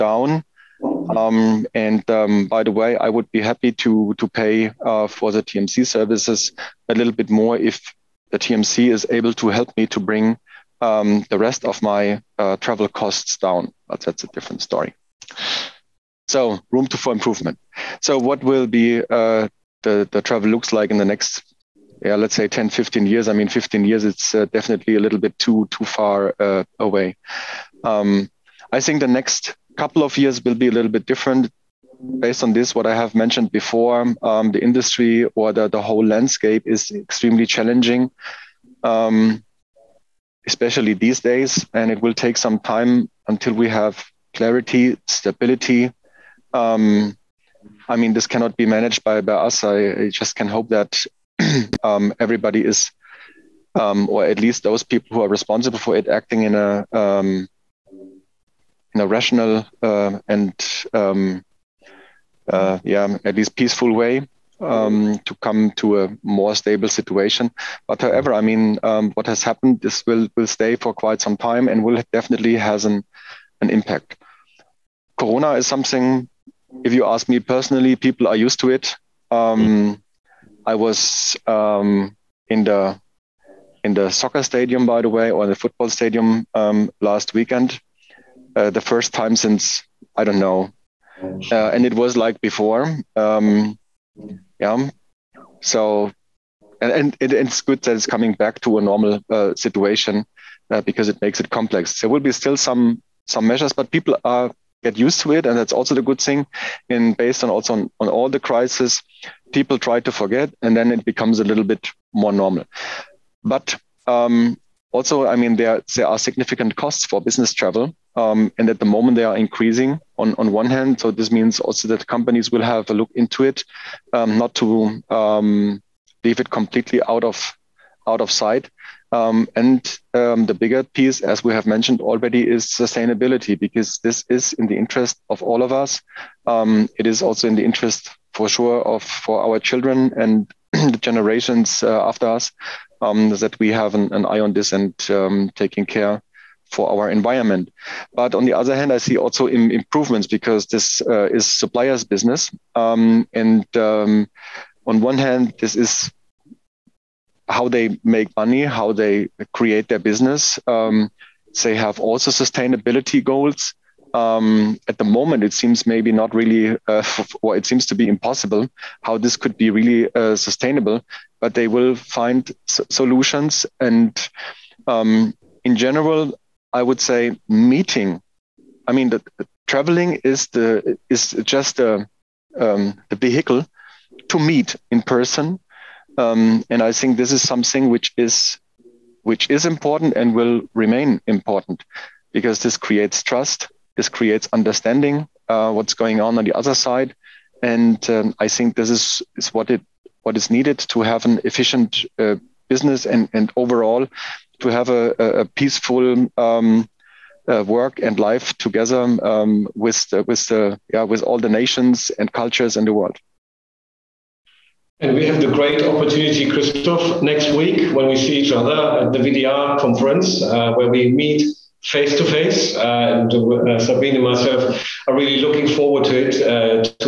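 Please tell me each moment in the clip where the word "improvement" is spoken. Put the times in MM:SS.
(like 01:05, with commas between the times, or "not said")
00:17, 02:29.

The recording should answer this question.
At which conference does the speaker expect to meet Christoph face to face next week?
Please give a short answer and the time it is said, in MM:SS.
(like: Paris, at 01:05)
VDR conference, at 03:39.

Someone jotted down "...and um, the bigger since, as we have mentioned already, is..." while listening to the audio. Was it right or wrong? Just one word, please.
wrong.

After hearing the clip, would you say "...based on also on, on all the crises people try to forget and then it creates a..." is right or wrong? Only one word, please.
wrong.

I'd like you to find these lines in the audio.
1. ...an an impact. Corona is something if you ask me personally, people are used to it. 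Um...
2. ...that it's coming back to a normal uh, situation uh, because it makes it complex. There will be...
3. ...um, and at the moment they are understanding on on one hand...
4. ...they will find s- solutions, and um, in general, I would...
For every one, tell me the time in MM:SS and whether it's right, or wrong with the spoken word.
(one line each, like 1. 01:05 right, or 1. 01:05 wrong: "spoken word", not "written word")
1. 01:12 right
2. 01:37 right
3. 01:58 wrong: "increasing", not "understanding"
4. 02:51 right.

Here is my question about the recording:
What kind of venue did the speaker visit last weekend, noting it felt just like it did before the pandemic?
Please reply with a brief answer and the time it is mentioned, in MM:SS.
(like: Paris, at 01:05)
football stadium, at 01:25.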